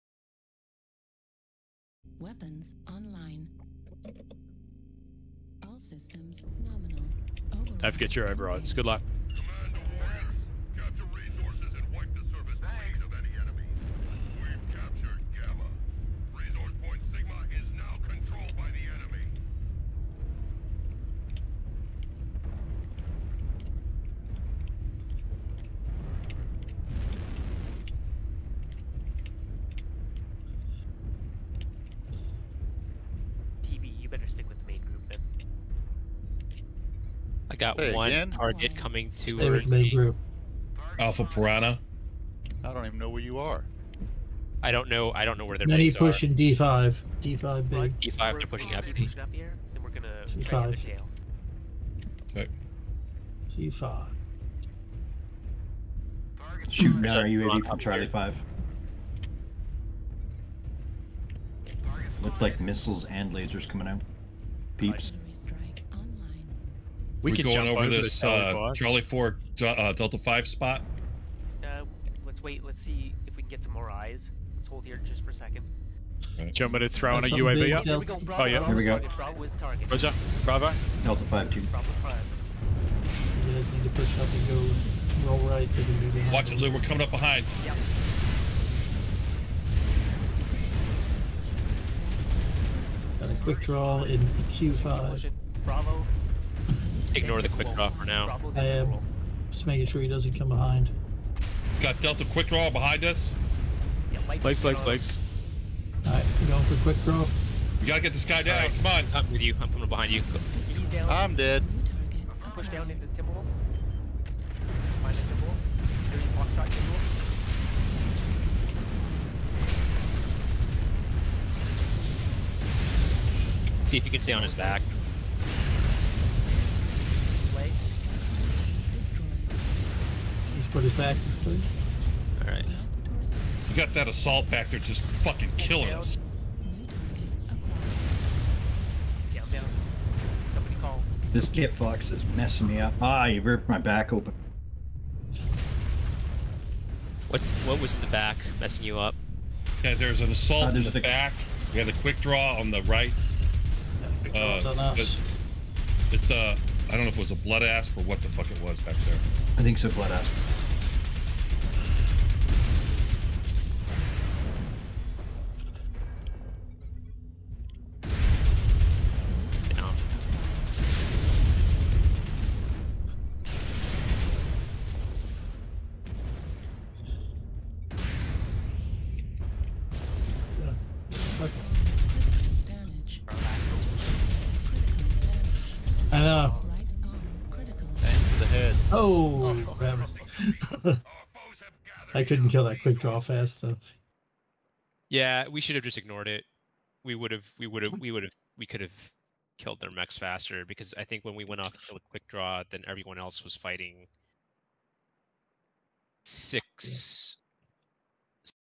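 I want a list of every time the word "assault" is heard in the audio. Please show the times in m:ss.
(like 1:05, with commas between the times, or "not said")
2:14, 2:30.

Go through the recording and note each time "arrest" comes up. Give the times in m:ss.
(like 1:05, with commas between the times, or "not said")
not said.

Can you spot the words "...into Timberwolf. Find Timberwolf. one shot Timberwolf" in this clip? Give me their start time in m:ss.
1:52.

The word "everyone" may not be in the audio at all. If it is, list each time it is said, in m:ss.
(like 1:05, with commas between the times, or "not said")
3:22.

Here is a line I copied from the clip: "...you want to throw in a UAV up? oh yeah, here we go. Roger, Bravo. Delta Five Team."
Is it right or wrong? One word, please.
right.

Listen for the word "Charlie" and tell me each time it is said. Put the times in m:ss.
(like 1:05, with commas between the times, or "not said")
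0:57, 1:08.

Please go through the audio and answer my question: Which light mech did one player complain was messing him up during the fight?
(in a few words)
Kit Fox.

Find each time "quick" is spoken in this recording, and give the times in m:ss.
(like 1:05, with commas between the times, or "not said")
1:33, 1:37, 1:42, 1:46, 2:32, 3:12, 3:22.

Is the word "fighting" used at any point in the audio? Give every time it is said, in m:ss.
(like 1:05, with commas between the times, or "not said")
3:23.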